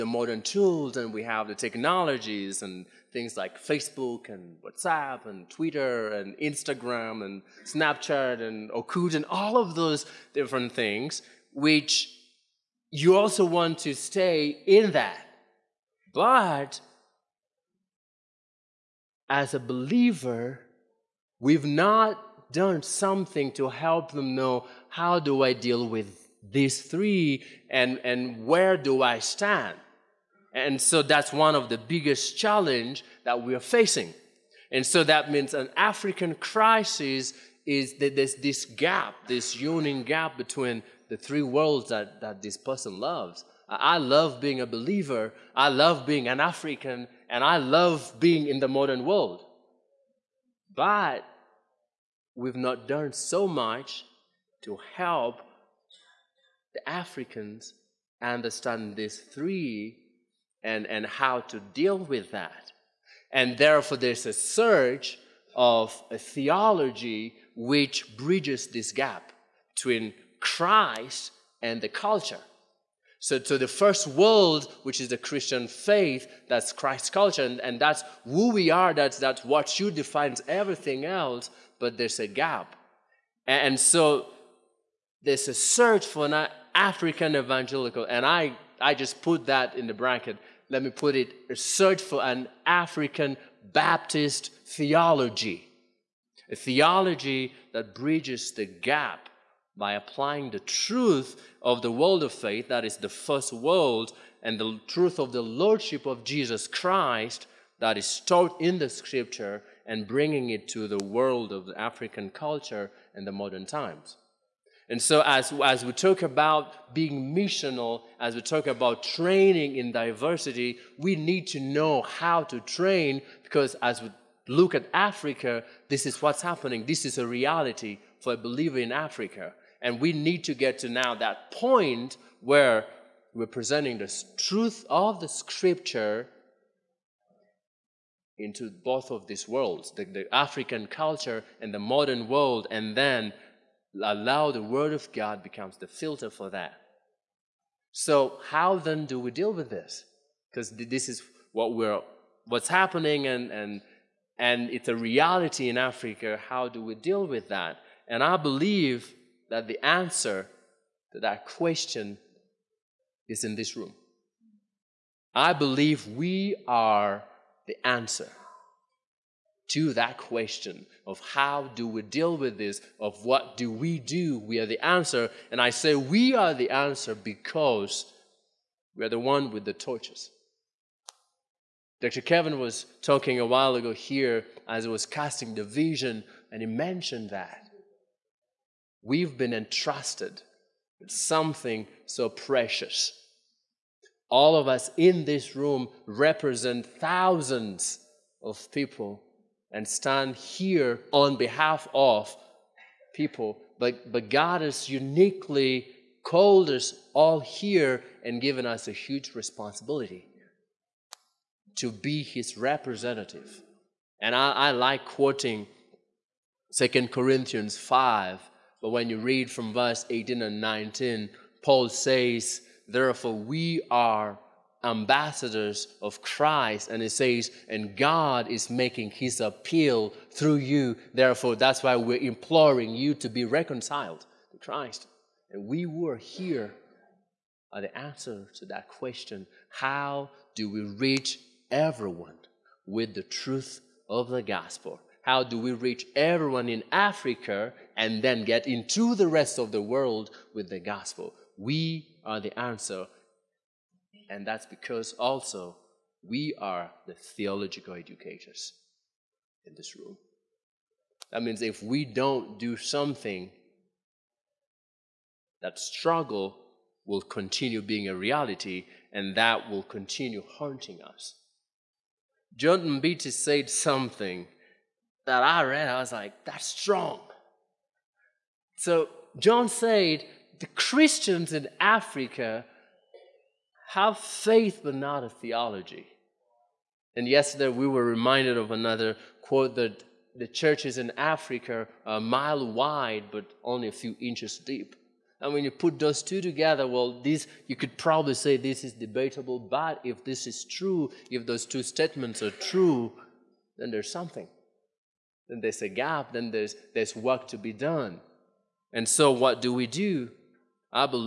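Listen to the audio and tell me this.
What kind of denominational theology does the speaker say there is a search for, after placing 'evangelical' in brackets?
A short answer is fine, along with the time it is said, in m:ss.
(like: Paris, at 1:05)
African Baptist theology, at 1:32.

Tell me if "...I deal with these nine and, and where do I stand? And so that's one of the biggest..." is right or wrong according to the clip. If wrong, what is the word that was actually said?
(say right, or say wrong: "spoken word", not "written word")
wrong: "three", not "nine".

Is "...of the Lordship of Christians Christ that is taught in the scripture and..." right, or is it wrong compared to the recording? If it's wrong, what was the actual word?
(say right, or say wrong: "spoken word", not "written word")
wrong: "Jesus", not "Christians".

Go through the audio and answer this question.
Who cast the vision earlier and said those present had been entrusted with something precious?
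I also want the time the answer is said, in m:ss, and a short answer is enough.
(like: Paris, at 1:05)
Dr. Kevin, at 3:01.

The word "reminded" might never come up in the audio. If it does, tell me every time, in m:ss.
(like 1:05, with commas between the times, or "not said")
4:48.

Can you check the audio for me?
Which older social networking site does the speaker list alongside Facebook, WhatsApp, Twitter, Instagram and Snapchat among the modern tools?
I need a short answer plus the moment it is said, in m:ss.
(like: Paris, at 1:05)
Orkut, at 0:08.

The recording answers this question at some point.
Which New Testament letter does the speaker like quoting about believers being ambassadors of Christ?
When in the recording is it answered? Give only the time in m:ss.
3:36.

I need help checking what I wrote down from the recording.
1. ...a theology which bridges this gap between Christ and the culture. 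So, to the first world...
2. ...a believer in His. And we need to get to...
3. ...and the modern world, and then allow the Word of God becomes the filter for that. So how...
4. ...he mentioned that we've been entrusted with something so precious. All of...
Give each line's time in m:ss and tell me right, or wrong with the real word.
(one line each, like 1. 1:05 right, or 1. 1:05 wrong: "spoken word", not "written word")
1. 1:06 right
2. 2:08 wrong: "Africa", not "His"
3. 2:21 right
4. 3:06 right.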